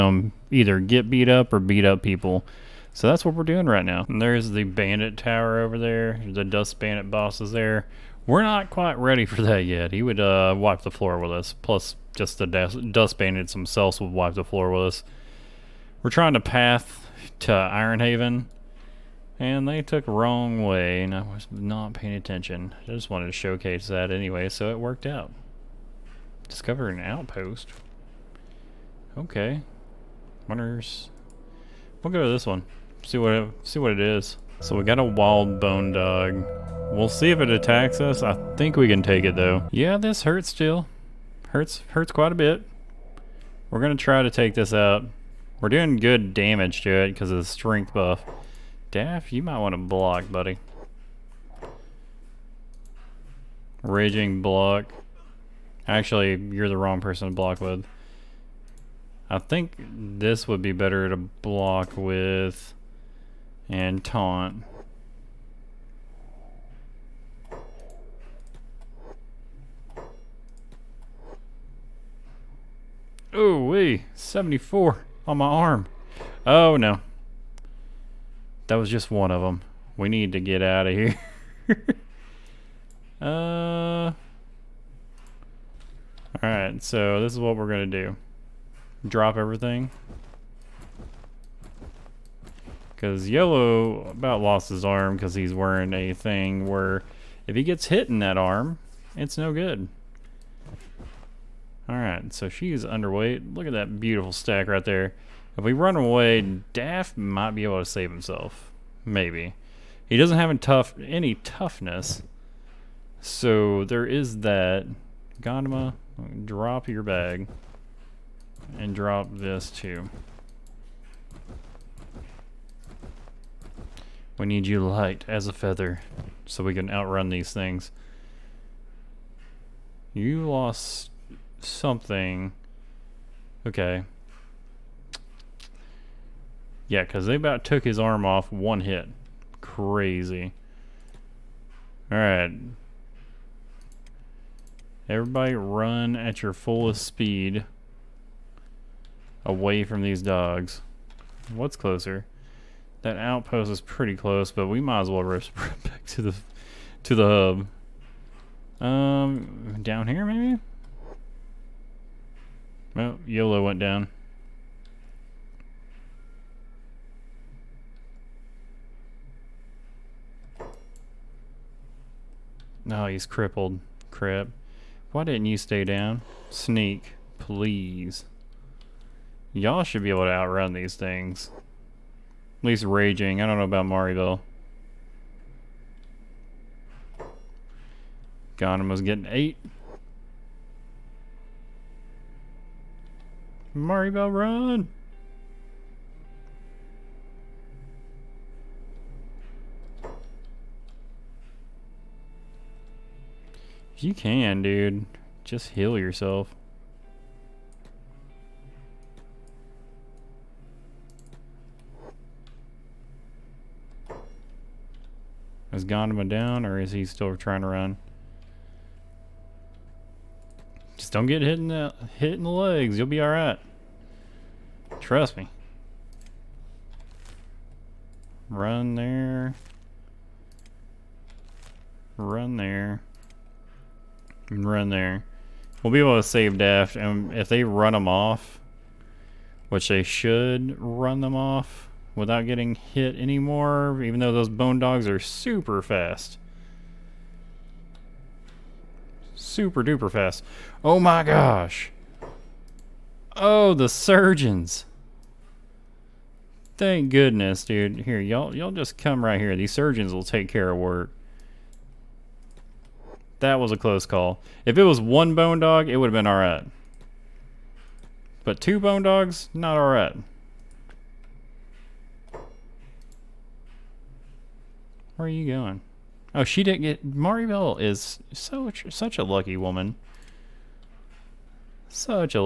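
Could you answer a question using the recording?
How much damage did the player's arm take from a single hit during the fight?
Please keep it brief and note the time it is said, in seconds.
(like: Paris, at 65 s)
74, at 74 s.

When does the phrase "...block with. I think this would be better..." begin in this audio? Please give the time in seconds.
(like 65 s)
57 s.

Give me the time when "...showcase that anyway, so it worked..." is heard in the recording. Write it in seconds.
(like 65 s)
23 s.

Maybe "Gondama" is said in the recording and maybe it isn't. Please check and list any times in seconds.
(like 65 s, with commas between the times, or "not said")
115 s, 215 s.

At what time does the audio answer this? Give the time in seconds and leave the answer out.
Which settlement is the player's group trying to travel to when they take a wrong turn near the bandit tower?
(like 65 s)
17 s.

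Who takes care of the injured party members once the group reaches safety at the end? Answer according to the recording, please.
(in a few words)
The surgeons.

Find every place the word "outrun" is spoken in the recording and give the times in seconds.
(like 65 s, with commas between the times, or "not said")
126 s, 180 s.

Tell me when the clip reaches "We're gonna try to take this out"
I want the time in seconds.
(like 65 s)
43 s.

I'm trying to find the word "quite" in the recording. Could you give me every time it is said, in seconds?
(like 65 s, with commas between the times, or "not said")
8 s, 42 s.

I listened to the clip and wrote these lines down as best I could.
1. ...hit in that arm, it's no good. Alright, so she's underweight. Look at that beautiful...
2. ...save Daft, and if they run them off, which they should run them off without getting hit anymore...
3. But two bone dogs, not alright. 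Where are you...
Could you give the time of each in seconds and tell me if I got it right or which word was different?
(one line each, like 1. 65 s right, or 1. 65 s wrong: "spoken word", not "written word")
1. 97 s right
2. 236 s right
3. 268 s right.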